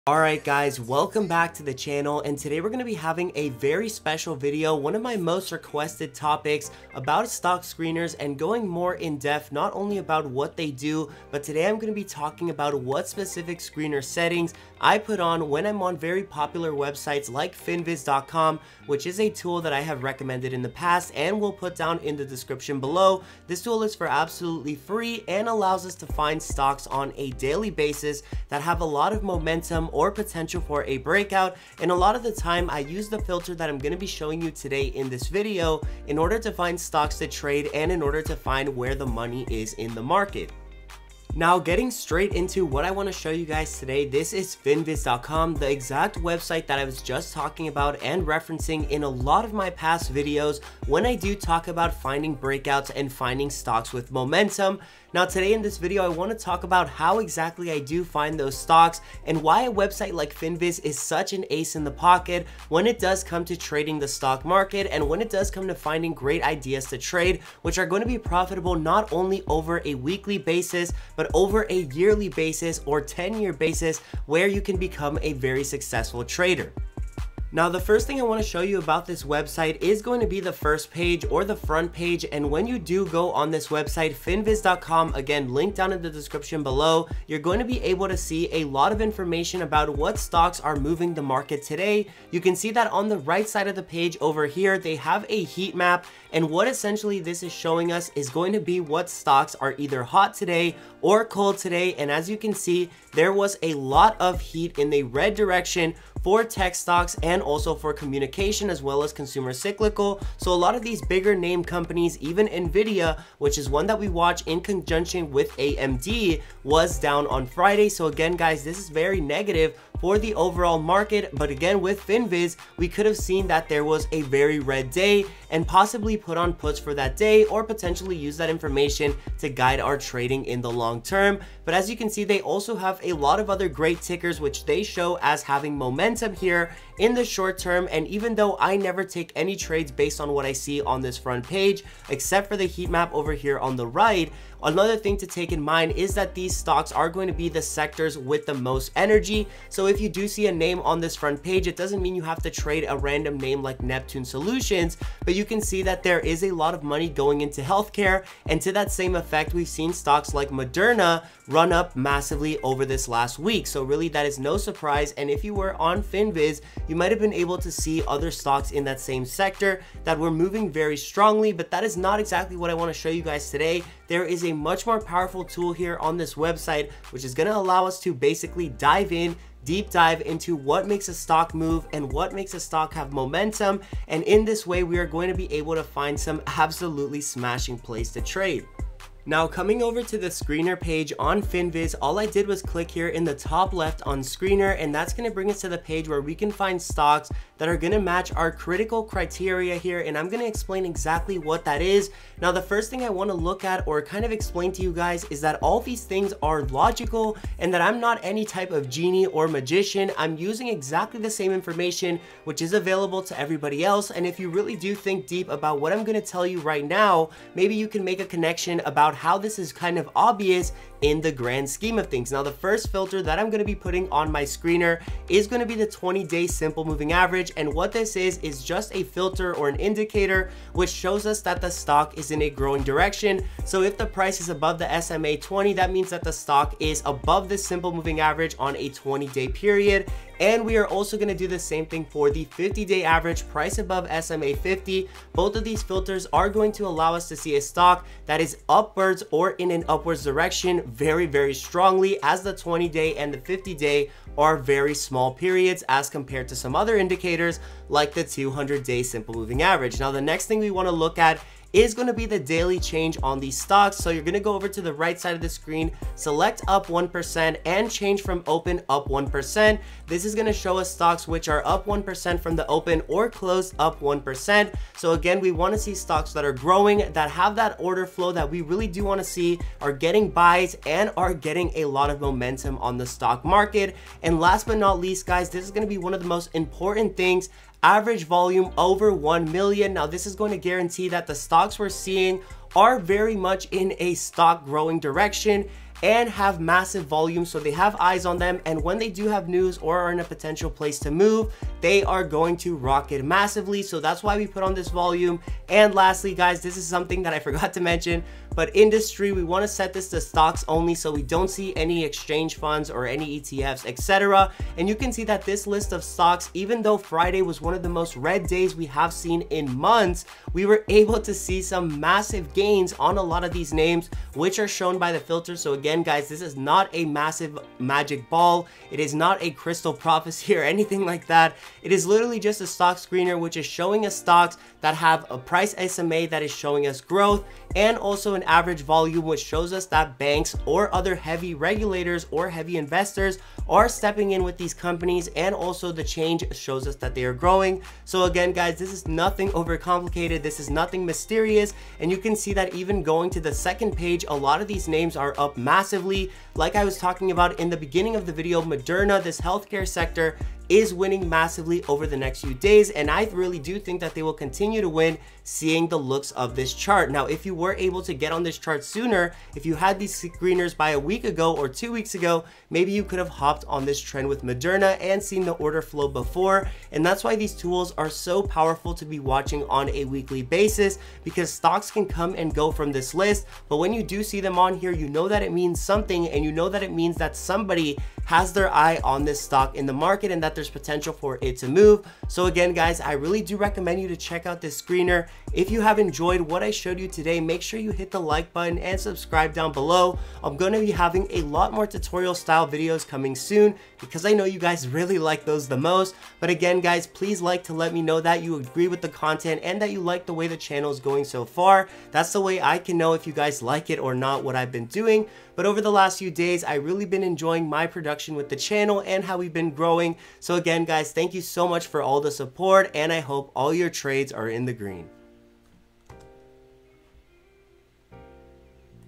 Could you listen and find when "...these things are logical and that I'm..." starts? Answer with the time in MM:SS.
03:25.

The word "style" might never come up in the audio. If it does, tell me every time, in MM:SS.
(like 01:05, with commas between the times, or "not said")
06:42.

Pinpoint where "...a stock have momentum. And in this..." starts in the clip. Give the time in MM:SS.
03:02.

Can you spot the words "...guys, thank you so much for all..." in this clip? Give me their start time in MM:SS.
07:00.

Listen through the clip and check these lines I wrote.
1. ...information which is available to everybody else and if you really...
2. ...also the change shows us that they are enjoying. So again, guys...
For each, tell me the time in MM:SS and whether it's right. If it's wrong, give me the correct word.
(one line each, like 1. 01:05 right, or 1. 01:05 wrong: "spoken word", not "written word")
1. 03:31 right
2. 05:45 wrong: "growing", not "enjoying".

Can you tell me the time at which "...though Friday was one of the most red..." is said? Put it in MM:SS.
05:16.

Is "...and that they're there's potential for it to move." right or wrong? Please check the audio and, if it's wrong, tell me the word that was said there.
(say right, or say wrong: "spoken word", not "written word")
right.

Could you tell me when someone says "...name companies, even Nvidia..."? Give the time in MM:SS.
01:51.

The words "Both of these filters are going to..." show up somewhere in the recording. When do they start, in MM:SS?
04:05.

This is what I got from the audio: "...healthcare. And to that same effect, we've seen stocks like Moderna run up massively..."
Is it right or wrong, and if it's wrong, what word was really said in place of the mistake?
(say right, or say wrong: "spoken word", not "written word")
right.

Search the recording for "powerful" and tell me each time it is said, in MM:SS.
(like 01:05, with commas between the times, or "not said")
02:54, 06:18.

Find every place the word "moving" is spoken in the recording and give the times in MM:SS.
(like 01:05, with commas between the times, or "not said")
01:30, 02:50, 03:46, 03:57, 04:19.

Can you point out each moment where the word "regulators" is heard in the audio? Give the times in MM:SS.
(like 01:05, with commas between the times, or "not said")
05:41.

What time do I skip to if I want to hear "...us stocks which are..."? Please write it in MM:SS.
04:30.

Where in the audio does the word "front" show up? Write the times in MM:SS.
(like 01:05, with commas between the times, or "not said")
01:21, 02:21, 02:31.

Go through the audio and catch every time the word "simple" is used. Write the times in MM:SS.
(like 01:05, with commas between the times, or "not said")
03:46, 03:57, 04:19.